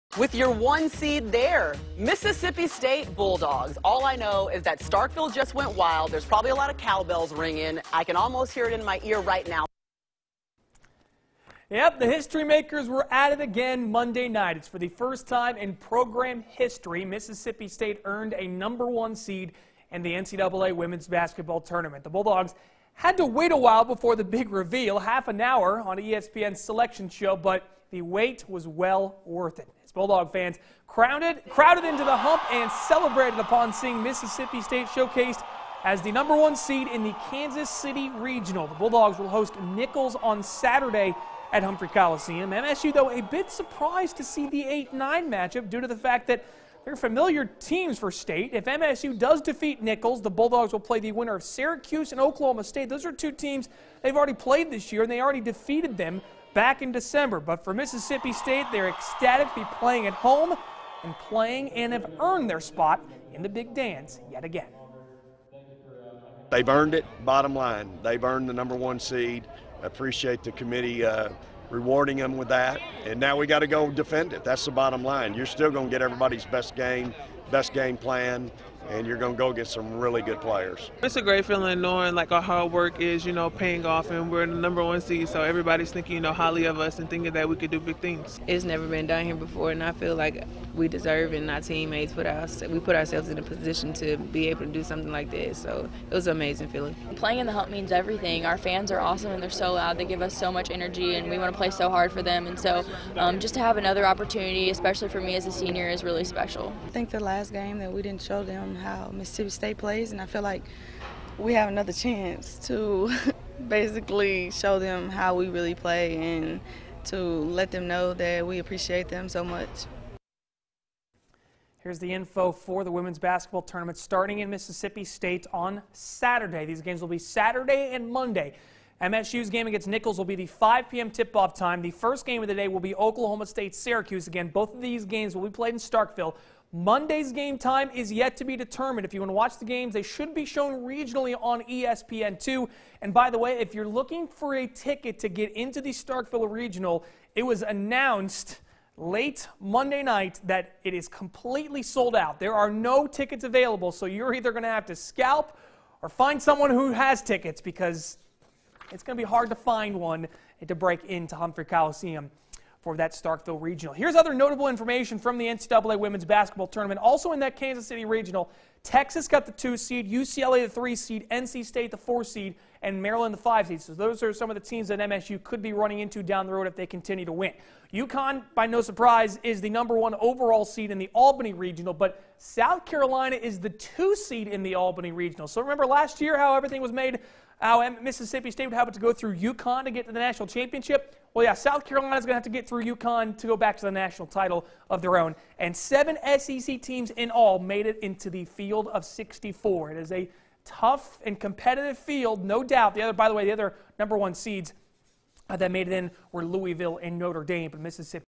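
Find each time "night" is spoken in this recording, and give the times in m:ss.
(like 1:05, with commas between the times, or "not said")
0:14, 2:30.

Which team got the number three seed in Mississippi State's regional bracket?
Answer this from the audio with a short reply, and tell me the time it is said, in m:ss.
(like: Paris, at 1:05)
UCLA, at 2:50.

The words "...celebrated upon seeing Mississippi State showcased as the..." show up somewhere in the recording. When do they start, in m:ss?
0:32.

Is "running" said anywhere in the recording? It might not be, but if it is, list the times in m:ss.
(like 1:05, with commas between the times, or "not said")
2:55.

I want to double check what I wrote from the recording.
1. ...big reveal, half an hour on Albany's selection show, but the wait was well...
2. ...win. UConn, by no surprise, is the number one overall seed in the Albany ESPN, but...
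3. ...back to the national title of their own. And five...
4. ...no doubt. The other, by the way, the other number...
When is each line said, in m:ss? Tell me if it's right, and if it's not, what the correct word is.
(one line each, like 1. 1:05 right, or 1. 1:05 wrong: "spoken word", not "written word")
1. 0:24 wrong: "ESPN", not "Albany"
2. 2:57 wrong: "Regional", not "ESPN"
3. 3:13 wrong: "seven", not "five"
4. 3:22 right.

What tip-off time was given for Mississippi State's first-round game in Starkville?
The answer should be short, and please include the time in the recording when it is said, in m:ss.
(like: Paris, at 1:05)
5 p.m., at 2:10.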